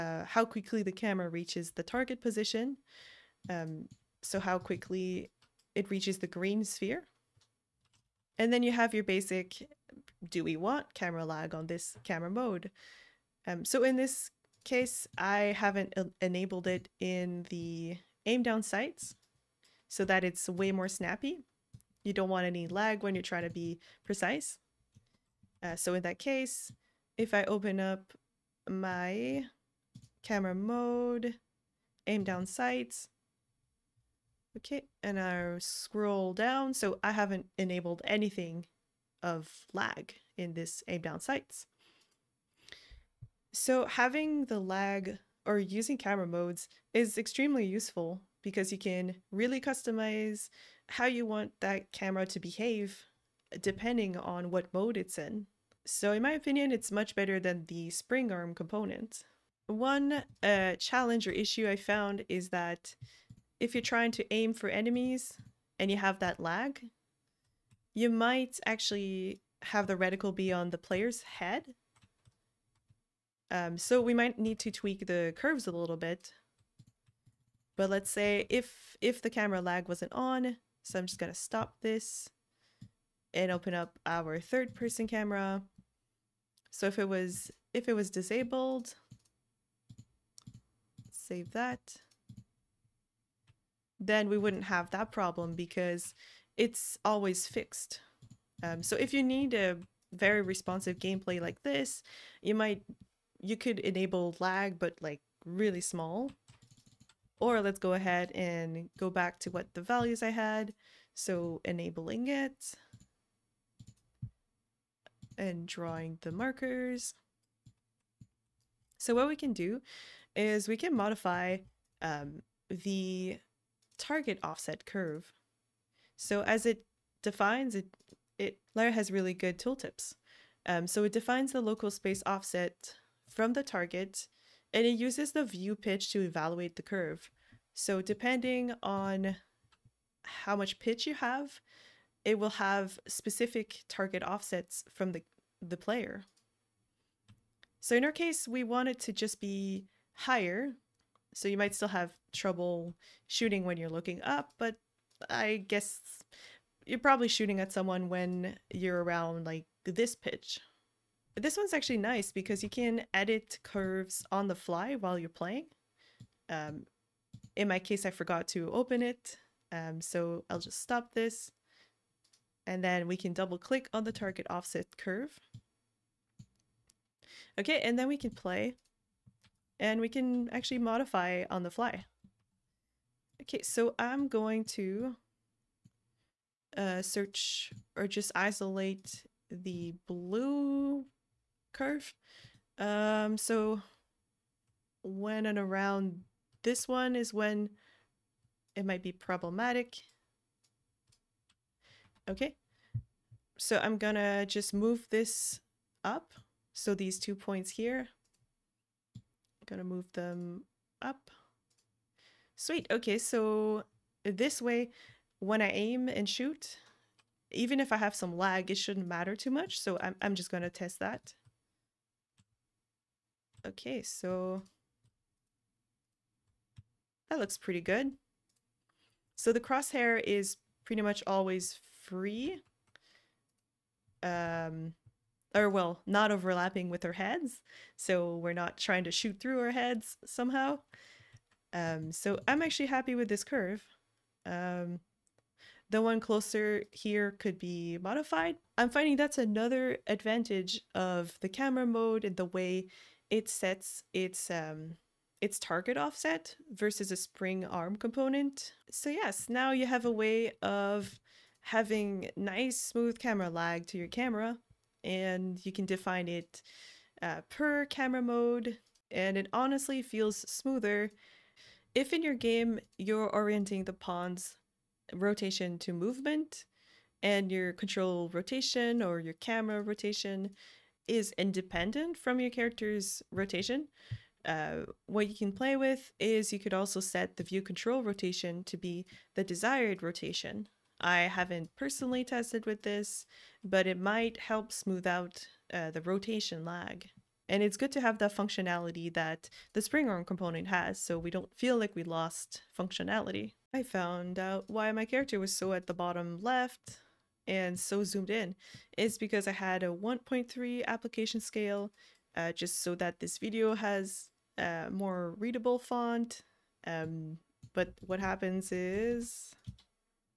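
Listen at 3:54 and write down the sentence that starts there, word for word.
Um, or well, not overlapping with our heads.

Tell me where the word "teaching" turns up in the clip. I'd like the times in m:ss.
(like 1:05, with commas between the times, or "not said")
not said.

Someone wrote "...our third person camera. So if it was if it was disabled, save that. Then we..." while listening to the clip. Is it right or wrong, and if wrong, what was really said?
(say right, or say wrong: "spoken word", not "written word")
right.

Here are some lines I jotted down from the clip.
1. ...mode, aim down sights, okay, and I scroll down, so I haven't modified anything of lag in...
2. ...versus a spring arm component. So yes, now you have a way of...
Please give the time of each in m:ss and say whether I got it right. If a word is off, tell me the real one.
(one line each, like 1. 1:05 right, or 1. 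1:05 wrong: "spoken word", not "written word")
1. 0:30 wrong: "enabled", not "modified"
2. 4:16 right.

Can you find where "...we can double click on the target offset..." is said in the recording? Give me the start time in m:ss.
2:53.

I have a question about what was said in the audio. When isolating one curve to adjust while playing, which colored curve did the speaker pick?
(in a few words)
Blue.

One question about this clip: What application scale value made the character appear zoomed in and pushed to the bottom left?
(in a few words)
1.3.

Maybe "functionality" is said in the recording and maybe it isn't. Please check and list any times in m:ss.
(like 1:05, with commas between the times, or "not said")
4:58, 5:02.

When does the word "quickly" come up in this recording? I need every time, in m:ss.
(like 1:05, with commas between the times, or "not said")
0:00, 0:04.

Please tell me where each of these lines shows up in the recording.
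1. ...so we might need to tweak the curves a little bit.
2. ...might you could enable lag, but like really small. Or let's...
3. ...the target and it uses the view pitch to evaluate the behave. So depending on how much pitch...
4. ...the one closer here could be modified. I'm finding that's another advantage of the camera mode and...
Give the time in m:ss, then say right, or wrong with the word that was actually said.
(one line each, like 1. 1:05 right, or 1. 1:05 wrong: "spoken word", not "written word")
1. 1:13 right
2. 1:42 right
3. 2:13 wrong: "curve", not "behave"
4. 4:05 right.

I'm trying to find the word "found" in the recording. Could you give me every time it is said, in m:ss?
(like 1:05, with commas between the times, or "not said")
1:01, 5:03.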